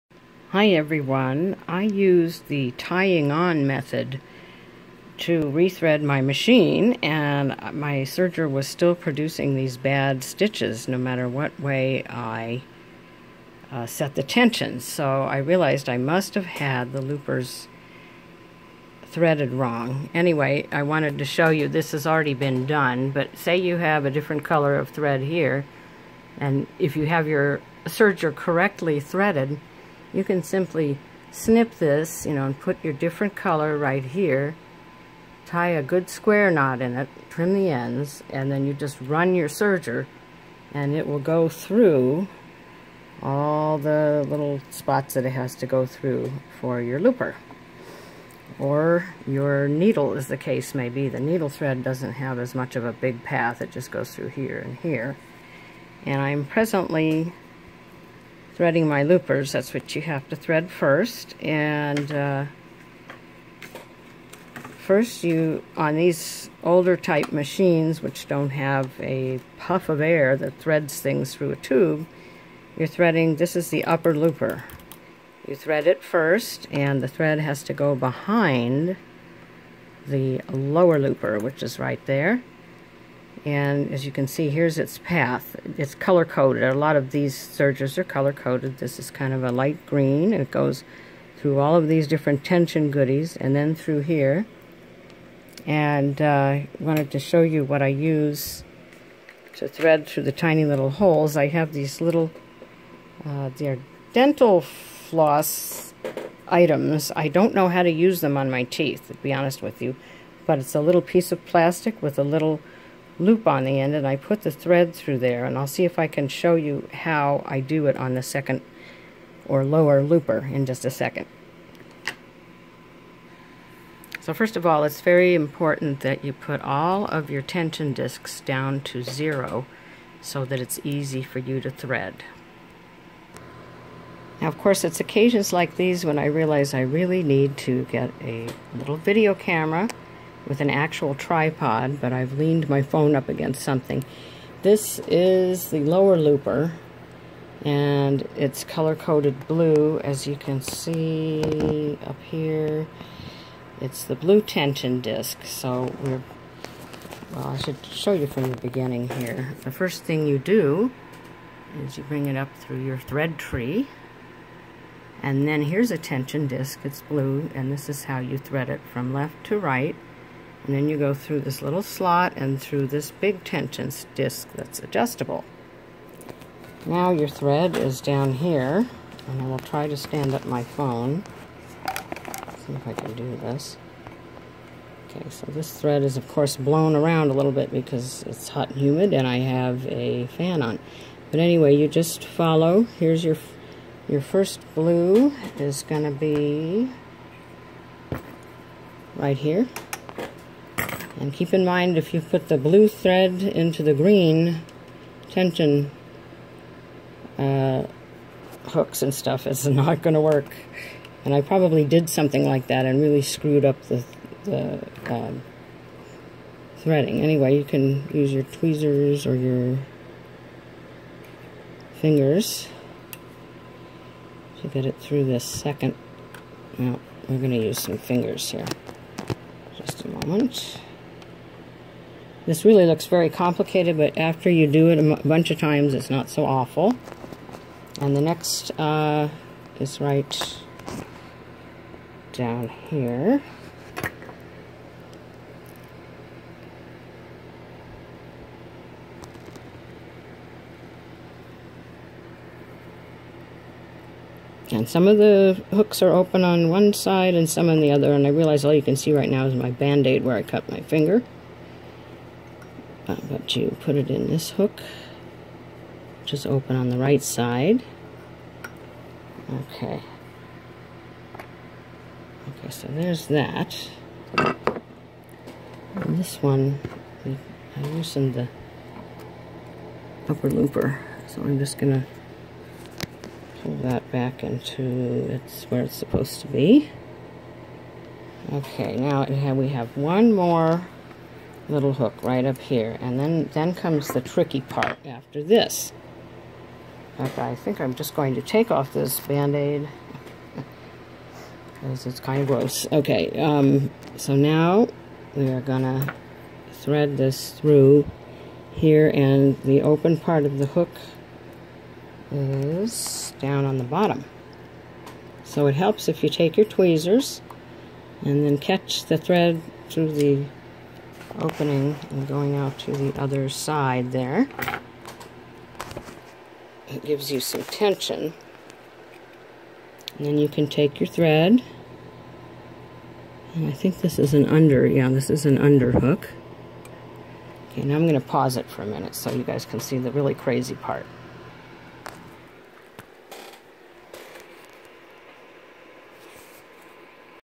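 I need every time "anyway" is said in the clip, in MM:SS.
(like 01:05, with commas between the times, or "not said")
00:20, 03:11, 03:37.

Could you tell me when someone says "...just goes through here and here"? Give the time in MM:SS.
00:53.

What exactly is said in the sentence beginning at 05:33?
And I think this is an under, yeah, this is an underhook.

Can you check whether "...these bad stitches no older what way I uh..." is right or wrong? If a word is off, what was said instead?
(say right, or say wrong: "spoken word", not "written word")
wrong: "matter", not "older".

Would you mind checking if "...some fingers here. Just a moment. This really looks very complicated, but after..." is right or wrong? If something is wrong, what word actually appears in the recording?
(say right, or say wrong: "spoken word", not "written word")
right.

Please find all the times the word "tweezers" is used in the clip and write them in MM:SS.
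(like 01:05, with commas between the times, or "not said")
03:38, 05:16.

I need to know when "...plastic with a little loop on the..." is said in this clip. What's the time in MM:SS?
01:51.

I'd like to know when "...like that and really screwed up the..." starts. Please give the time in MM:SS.
03:32.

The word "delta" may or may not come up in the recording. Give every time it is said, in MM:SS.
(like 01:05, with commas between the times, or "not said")
not said.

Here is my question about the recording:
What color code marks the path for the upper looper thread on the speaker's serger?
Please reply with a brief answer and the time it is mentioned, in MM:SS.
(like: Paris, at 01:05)
light green, at 01:29.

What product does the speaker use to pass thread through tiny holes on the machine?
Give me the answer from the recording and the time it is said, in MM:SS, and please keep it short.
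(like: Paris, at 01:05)
dental floss items, at 01:44.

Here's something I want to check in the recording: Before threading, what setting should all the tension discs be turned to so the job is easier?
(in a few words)
0.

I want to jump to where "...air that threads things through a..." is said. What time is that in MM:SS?
01:09.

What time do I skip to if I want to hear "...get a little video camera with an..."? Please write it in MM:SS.
02:17.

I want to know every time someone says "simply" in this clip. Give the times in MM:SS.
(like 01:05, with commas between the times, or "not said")
00:30.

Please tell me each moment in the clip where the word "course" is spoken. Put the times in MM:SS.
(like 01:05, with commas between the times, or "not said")
02:14, 03:06.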